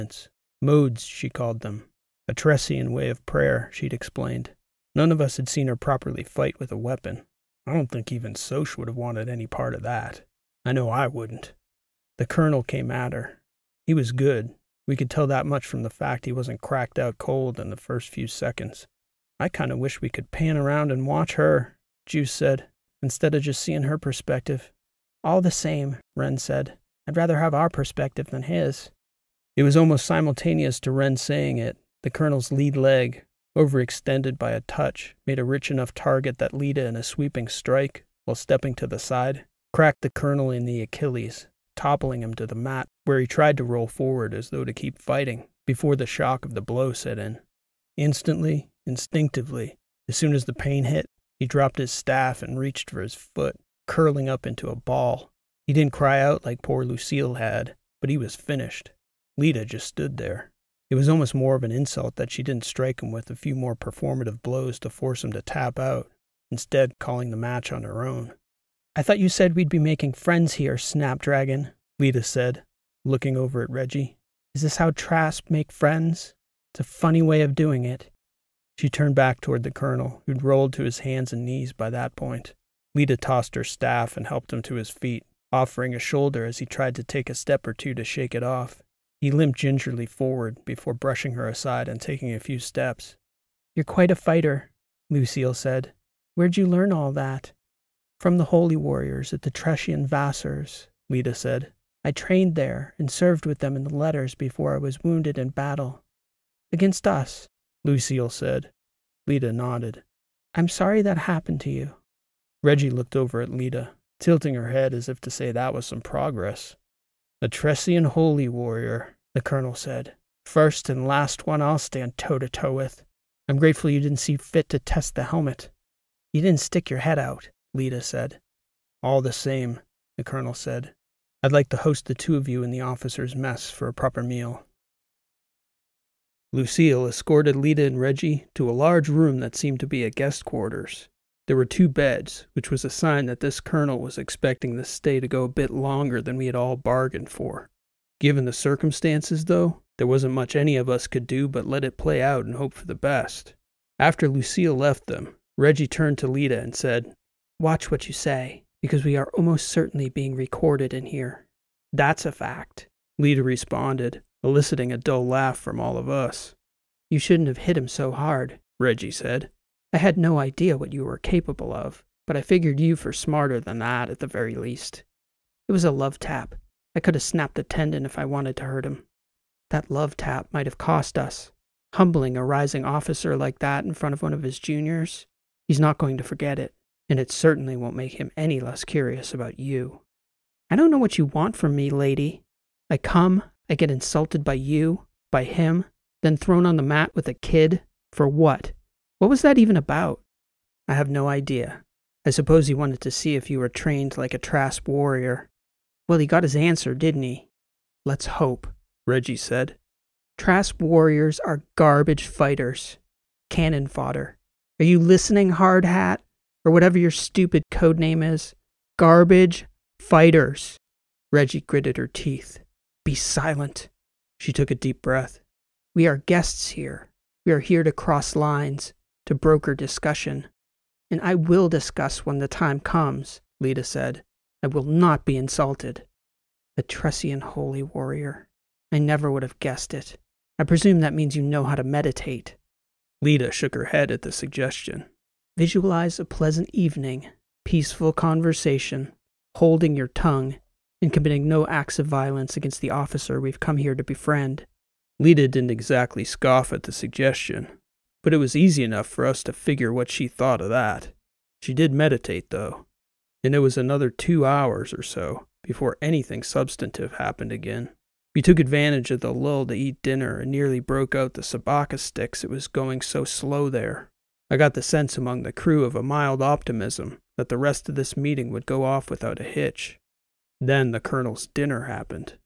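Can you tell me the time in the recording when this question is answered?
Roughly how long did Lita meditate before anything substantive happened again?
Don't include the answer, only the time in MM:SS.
04:24.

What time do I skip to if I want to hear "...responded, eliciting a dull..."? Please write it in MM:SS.
02:43.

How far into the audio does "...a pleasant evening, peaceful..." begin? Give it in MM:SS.
04:06.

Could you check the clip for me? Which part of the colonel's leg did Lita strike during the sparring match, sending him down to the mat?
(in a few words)
Achilles.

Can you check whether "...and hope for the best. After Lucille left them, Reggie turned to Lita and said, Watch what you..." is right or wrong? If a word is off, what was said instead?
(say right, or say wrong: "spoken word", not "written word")
right.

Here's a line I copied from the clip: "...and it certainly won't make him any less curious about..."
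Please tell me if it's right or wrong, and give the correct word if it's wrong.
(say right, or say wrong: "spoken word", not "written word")
right.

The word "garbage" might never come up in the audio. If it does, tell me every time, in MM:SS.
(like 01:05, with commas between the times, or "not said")
03:31, 03:38.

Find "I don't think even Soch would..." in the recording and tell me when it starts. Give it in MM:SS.
00:07.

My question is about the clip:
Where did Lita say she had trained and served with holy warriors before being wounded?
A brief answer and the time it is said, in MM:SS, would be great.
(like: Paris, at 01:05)
Tressian Vassars, at 01:39.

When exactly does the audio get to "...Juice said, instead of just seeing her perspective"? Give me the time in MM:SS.
00:22.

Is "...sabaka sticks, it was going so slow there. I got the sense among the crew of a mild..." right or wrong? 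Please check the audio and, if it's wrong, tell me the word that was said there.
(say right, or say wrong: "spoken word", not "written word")
right.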